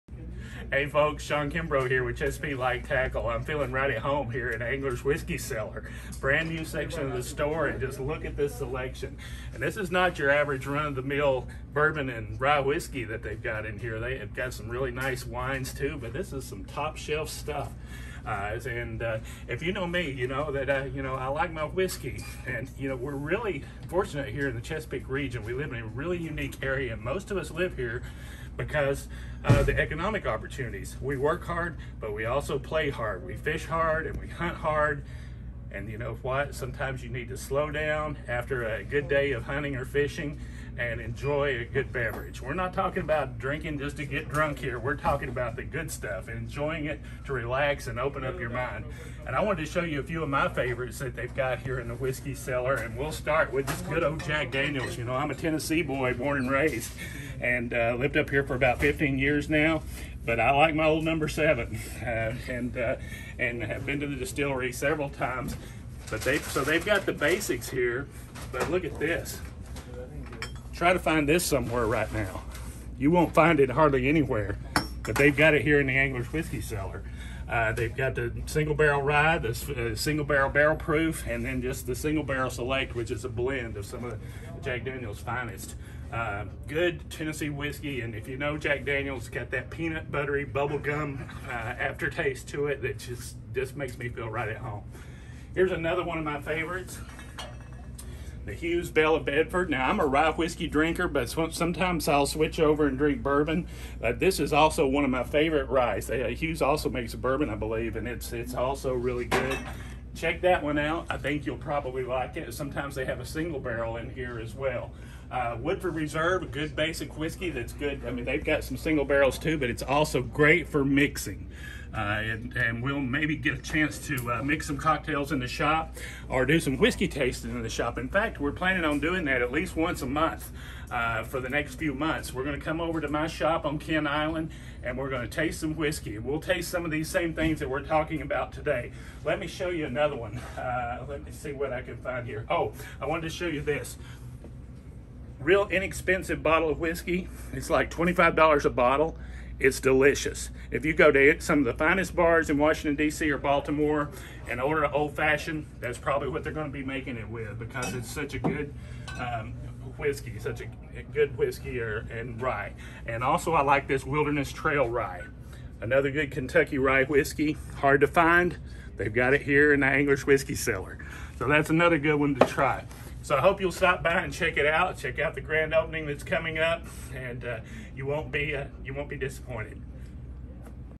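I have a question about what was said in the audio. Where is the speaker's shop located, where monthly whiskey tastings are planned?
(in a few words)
Kent Island.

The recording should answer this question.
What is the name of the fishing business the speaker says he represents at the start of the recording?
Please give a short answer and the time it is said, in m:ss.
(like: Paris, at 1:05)
Chesapeake Light Tackle, at 0:02.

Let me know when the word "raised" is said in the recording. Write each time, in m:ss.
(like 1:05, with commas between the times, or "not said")
0:56.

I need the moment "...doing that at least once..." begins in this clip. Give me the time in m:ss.
2:09.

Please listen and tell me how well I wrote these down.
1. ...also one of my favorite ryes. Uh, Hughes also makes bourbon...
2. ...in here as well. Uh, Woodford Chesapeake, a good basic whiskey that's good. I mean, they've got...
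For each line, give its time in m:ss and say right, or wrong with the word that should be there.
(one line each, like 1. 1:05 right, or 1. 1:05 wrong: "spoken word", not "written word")
1. 1:44 right
2. 1:53 wrong: "Reserve", not "Chesapeake".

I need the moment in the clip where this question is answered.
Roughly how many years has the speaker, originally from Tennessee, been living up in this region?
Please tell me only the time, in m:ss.
0:58.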